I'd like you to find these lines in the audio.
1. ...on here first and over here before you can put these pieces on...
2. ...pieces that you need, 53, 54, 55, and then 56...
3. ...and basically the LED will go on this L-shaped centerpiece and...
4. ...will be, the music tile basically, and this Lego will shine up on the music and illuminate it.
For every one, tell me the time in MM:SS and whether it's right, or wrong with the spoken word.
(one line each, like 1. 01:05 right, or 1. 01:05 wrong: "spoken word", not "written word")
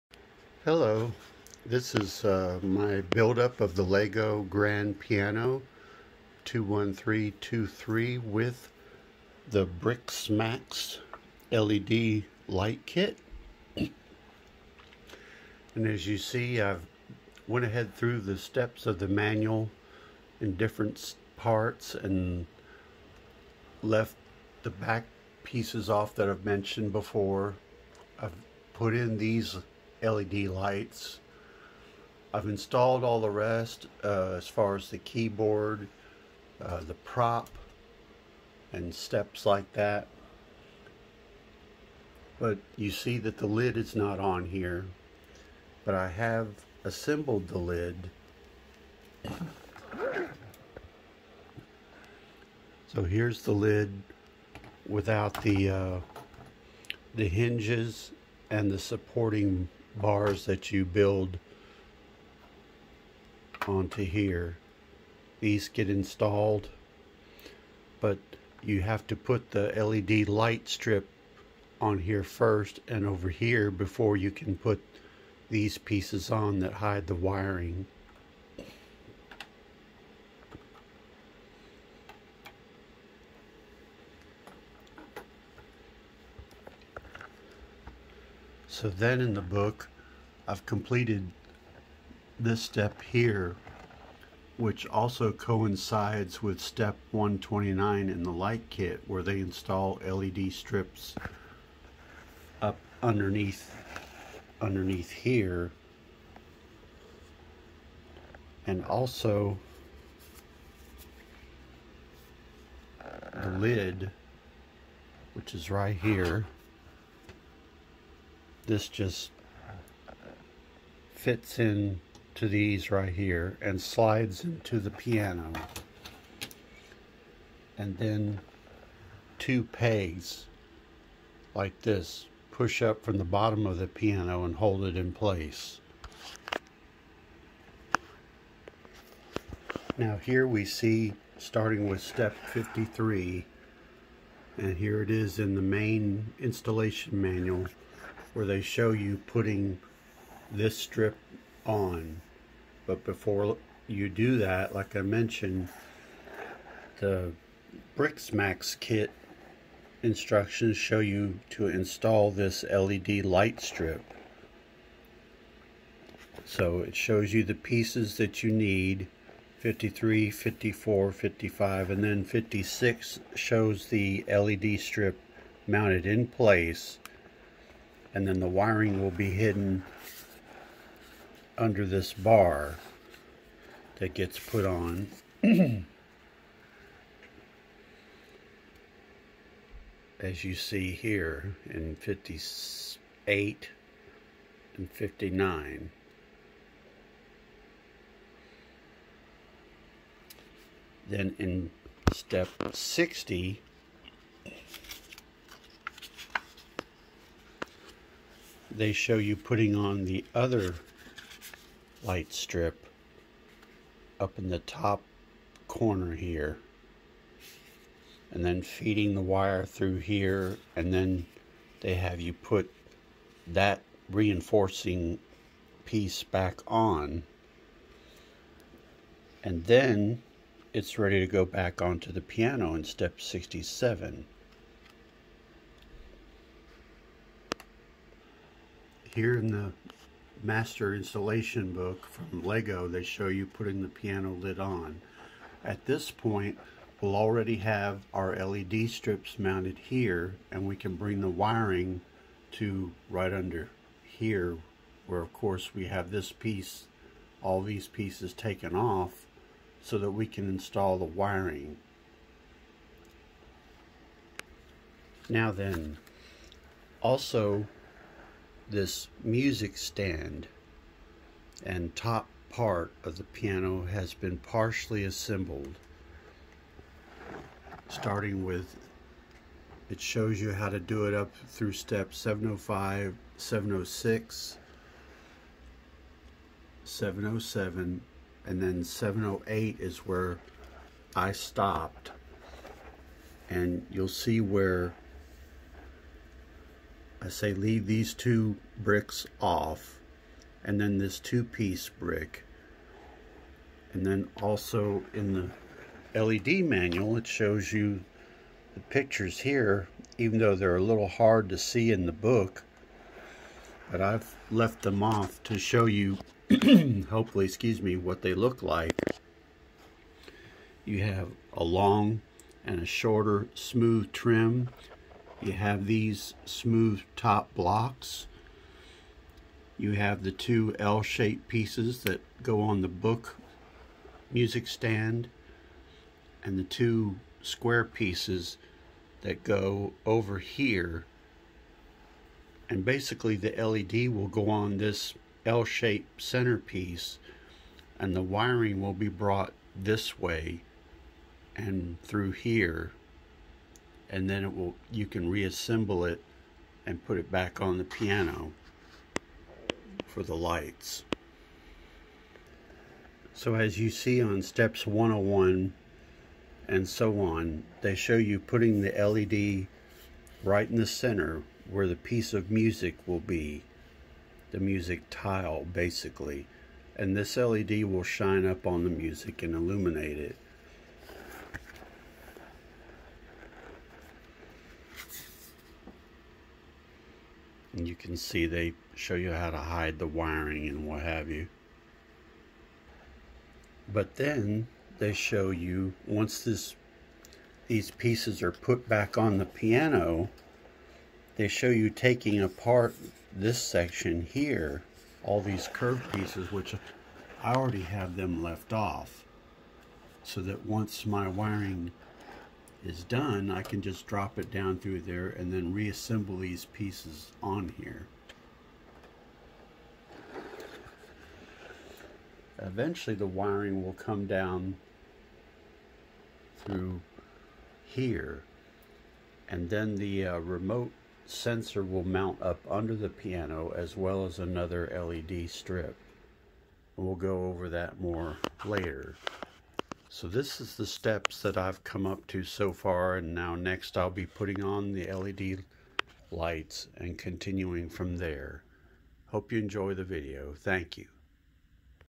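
1. 01:11 right
2. 02:47 right
3. 05:42 right
4. 06:13 wrong: "LED", not "Lego".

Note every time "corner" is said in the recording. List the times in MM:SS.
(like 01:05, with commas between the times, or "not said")
03:35.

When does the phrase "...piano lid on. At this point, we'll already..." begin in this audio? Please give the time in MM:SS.
04:03.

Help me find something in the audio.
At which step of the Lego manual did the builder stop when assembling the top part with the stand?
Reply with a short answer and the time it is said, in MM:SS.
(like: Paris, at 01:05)
708, at 04:48.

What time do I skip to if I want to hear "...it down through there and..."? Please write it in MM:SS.
06:54.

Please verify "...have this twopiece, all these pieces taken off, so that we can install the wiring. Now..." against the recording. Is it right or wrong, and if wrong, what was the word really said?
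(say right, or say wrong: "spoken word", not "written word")
wrong: "piece", not "twopiece".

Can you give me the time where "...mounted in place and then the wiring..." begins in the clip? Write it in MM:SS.
02:55.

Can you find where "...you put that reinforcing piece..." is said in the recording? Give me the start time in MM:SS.
03:42.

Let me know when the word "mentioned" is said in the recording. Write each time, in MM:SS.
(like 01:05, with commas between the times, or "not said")
00:26, 02:35.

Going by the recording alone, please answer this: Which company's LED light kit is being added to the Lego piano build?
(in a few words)
Briksmax.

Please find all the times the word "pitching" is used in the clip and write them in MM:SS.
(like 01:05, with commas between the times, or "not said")
not said.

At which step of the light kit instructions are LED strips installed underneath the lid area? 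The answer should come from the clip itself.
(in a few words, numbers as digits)
129.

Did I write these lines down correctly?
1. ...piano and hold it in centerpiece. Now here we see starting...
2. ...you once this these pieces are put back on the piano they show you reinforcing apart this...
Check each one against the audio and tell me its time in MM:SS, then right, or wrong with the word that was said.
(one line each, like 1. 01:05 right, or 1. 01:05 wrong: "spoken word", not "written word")
1. 02:13 wrong: "place", not "centerpiece"
2. 06:35 wrong: "taking", not "reinforcing".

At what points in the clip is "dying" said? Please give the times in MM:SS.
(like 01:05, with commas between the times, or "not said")
not said.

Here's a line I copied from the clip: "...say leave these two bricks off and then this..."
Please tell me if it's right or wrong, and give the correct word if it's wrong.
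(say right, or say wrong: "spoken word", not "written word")
right.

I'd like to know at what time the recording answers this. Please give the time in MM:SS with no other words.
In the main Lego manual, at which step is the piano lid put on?
03:53.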